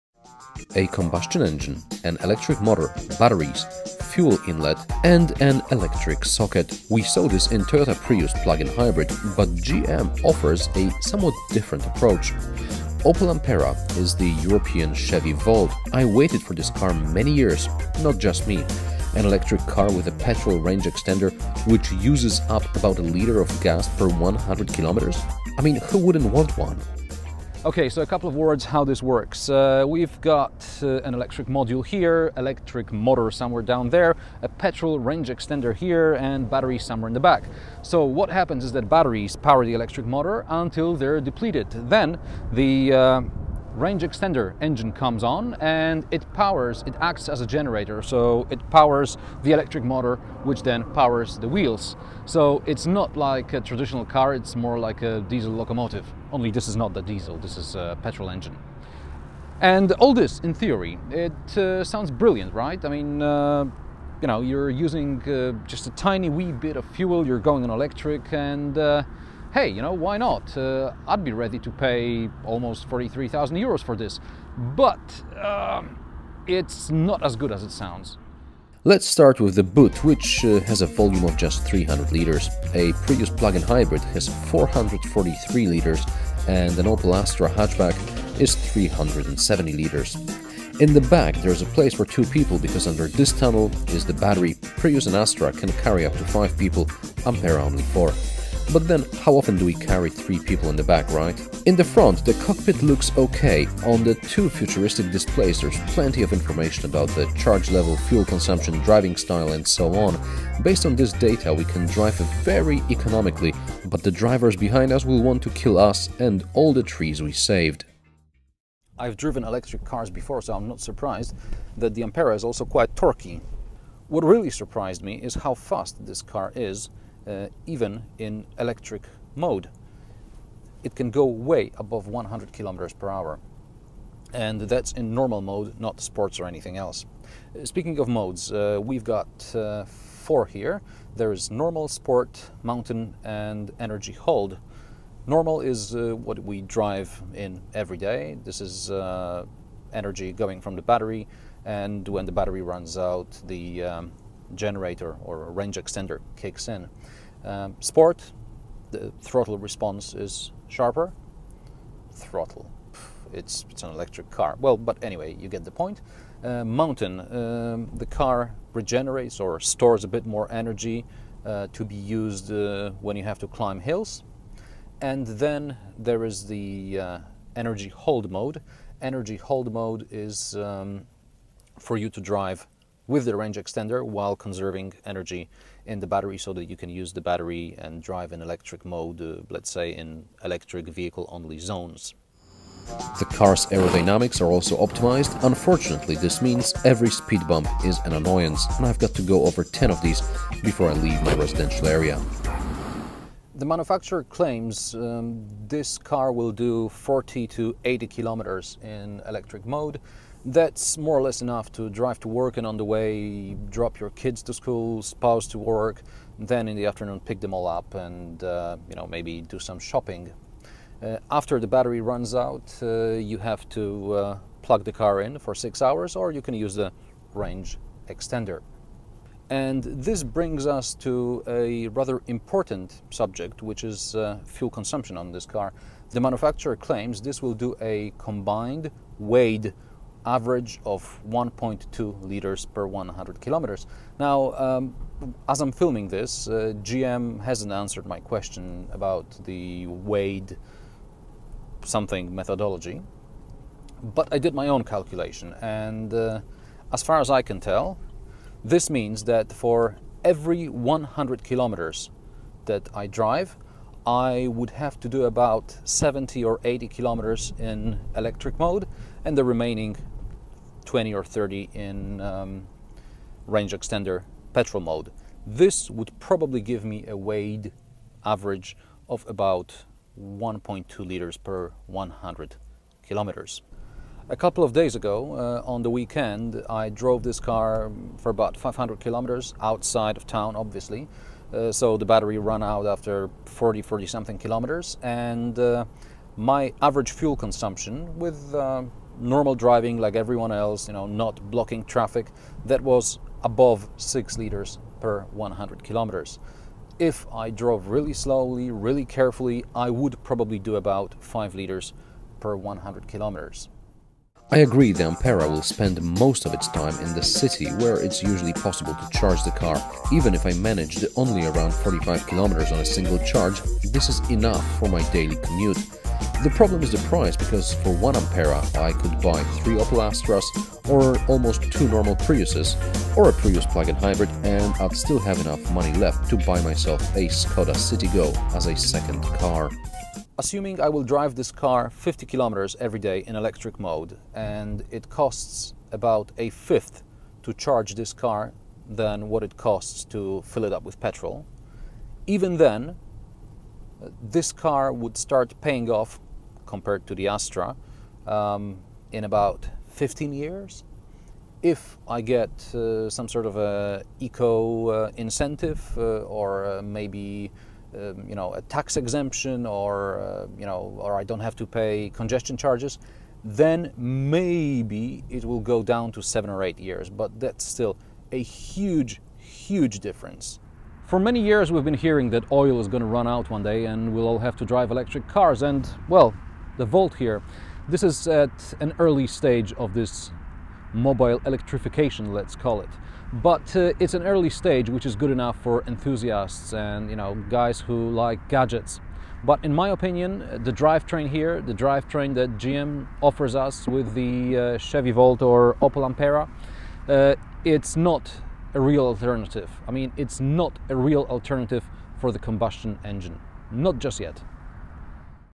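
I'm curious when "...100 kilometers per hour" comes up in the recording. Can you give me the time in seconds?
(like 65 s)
132 s.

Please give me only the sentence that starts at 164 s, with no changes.
Well, but anyway, you get the point.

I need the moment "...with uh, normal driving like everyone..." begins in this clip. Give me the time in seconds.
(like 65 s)
298 s.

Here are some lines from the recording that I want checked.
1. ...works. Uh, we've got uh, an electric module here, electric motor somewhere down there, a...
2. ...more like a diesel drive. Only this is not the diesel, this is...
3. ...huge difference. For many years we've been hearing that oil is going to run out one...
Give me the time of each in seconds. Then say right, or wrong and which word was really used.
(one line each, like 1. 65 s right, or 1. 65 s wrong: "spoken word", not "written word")
1. 29 s right
2. 54 s wrong: "locomotive", not "drive"
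3. 379 s right.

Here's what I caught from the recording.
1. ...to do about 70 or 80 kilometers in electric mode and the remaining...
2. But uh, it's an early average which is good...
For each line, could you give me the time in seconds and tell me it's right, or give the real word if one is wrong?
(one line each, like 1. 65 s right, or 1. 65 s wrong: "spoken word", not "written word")
1. 265 s right
2. 393 s wrong: "stage", not "average".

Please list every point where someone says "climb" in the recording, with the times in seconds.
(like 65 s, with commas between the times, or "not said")
173 s.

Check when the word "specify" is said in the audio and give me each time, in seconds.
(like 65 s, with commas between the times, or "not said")
not said.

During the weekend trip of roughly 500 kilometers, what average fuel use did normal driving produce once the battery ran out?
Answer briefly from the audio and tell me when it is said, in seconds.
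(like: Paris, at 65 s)
above 6 liters per 100 km, at 303 s.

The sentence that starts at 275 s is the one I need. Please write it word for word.
This would probably give me a weighed average of about 1.2 liters per 100 kilometers.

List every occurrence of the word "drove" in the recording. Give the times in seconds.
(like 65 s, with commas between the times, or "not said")
286 s, 307 s.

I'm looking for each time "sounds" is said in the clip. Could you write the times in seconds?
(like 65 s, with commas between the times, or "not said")
61 s, 77 s.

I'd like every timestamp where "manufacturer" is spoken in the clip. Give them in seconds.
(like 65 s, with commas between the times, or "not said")
203 s, 236 s.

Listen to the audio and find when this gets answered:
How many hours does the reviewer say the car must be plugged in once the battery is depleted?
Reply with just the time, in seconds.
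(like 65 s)
225 s.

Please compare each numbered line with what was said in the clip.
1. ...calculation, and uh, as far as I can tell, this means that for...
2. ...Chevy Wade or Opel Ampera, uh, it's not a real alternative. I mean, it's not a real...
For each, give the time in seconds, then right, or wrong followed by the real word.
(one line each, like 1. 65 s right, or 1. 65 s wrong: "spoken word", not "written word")
1. 254 s right
2. 404 s wrong: "Volt", not "Wade".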